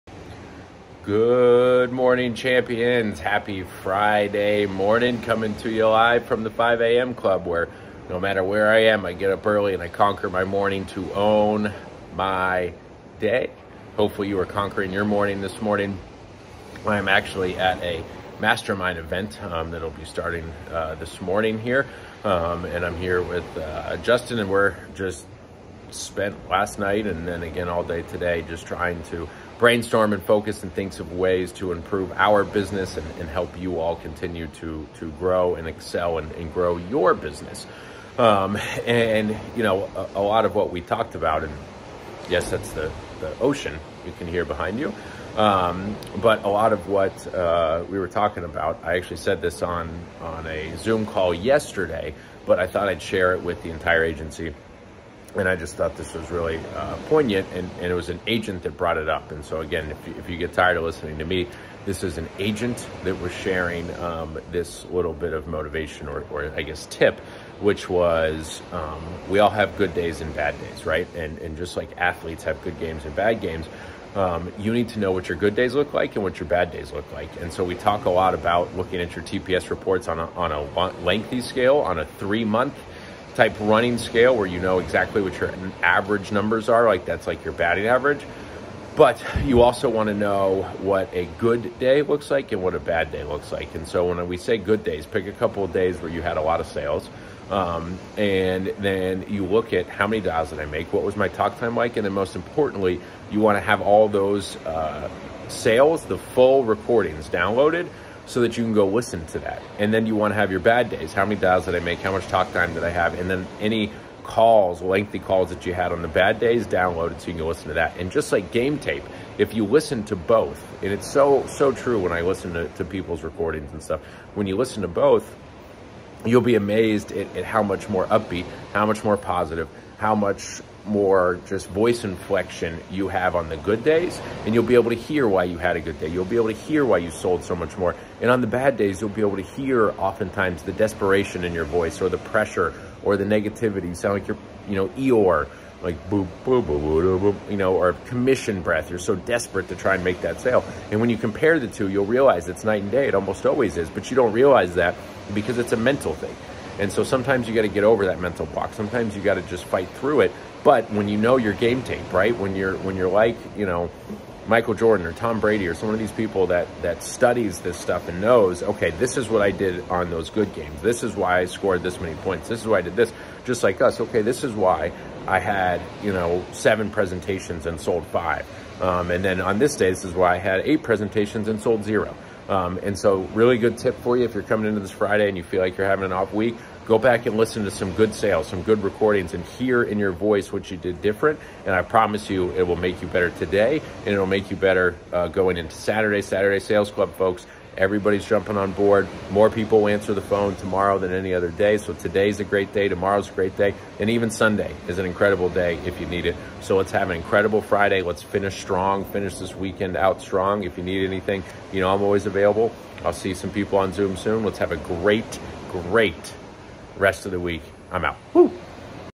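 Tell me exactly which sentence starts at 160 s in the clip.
But when you know your game tape, right?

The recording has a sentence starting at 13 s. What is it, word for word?
Hopefully, you are conquering your morning this morning.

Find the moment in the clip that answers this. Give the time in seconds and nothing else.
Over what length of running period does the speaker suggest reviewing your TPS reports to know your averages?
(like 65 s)
82 s.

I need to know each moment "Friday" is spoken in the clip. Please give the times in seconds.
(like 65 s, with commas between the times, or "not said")
3 s, 184 s, 207 s.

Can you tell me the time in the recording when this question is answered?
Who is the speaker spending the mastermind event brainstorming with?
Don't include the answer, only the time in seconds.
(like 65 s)
23 s.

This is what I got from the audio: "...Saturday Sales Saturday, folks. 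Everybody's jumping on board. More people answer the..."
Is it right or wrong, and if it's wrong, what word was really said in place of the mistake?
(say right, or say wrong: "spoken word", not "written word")
wrong: "Club", not "Saturday".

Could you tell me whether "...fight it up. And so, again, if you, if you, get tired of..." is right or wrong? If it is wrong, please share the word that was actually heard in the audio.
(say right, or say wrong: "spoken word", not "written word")
wrong: "brought", not "fight".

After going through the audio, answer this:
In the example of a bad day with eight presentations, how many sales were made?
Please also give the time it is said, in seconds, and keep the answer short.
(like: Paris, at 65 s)
0, at 181 s.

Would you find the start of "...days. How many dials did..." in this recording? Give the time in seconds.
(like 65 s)
110 s.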